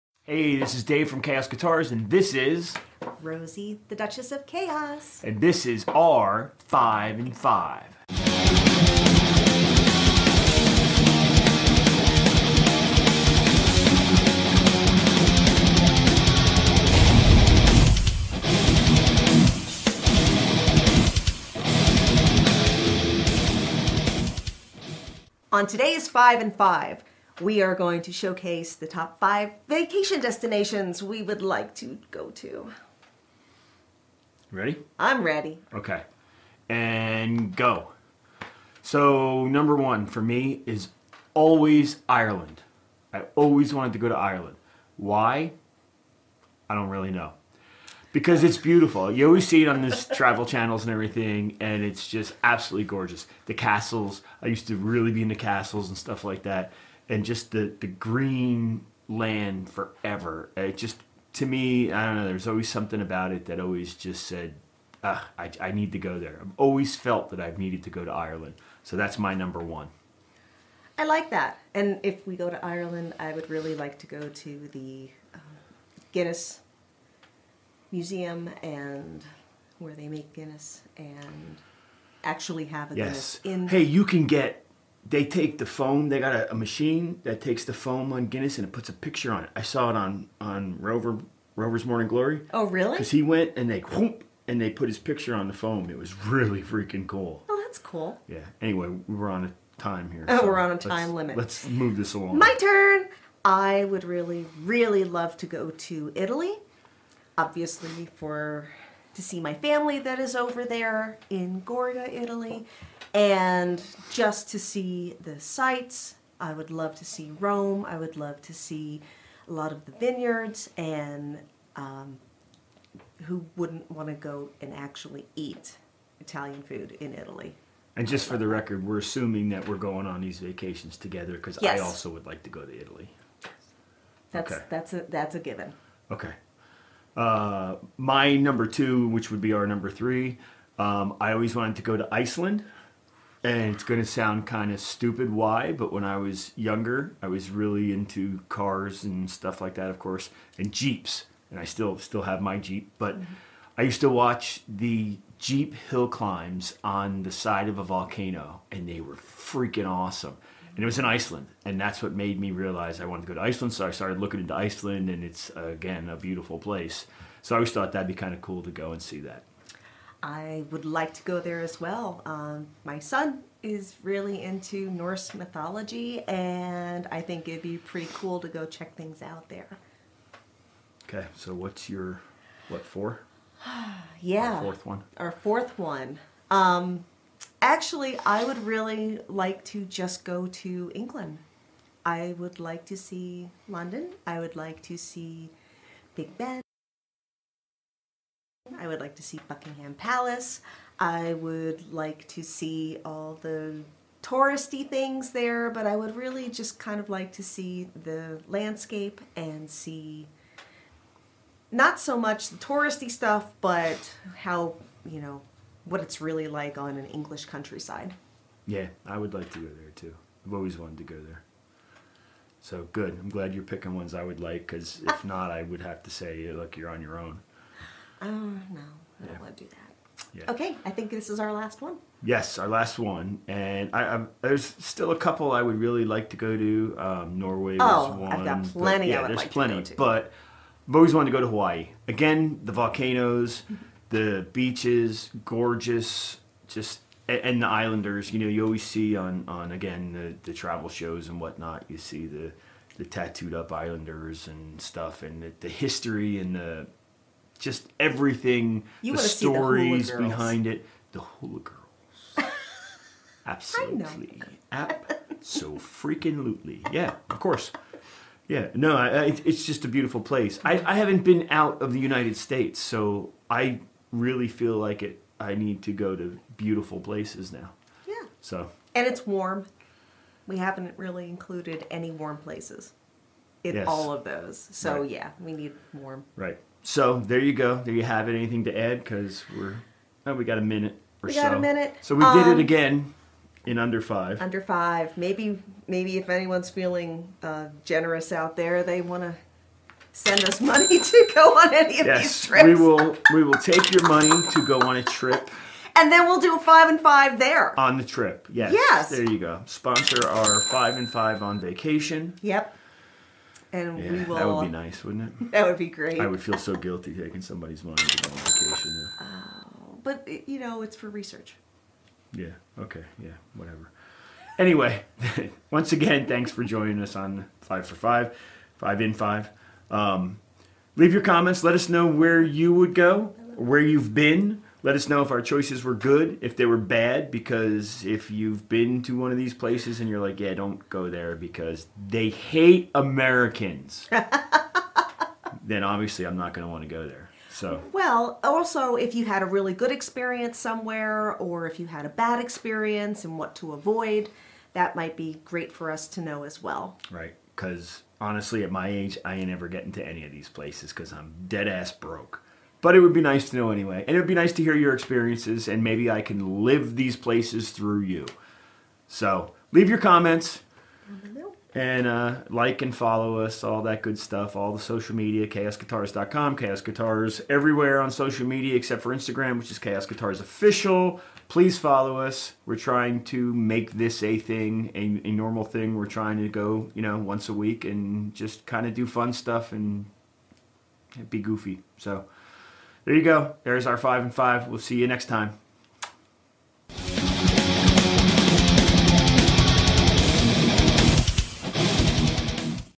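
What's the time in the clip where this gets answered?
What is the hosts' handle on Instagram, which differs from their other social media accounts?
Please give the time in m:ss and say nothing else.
6:19.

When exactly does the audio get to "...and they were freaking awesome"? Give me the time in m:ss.
2:38.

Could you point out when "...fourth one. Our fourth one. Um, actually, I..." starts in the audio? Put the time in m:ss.
3:04.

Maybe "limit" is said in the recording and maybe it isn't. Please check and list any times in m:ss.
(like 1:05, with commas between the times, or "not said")
1:41.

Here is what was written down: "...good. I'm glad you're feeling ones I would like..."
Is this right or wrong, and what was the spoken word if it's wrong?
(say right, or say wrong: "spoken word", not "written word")
wrong: "picking", not "feeling".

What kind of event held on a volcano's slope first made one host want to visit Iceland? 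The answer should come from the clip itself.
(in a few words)
Jeep hill climbs.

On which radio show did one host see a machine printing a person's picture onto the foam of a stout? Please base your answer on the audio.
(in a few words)
Rover's Morning Glory.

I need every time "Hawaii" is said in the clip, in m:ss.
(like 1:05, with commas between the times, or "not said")
4:01.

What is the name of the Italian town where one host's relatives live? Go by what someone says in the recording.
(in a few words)
Gorga.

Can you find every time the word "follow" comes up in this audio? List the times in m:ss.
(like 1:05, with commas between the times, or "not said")
6:12, 6:21.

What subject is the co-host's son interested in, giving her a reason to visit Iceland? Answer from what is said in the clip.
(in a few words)
Norse mythology.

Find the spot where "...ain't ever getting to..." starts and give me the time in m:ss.
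5:59.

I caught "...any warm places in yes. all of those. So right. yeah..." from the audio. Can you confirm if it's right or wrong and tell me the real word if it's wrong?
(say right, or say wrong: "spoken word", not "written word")
right.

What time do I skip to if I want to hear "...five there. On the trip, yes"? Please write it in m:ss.
5:07.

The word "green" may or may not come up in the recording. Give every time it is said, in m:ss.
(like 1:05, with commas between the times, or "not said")
0:57.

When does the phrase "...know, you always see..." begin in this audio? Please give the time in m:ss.
4:08.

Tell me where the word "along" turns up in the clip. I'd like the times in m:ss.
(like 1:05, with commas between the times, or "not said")
1:42.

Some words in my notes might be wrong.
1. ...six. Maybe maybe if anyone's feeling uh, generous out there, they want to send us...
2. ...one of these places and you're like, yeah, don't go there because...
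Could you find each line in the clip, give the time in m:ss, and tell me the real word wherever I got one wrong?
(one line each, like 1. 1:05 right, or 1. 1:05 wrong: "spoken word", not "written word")
1. 4:54 wrong: "five", not "six"
2. 5:39 right.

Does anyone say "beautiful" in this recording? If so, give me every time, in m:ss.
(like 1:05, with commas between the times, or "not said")
0:48, 2:46, 4:29, 4:36.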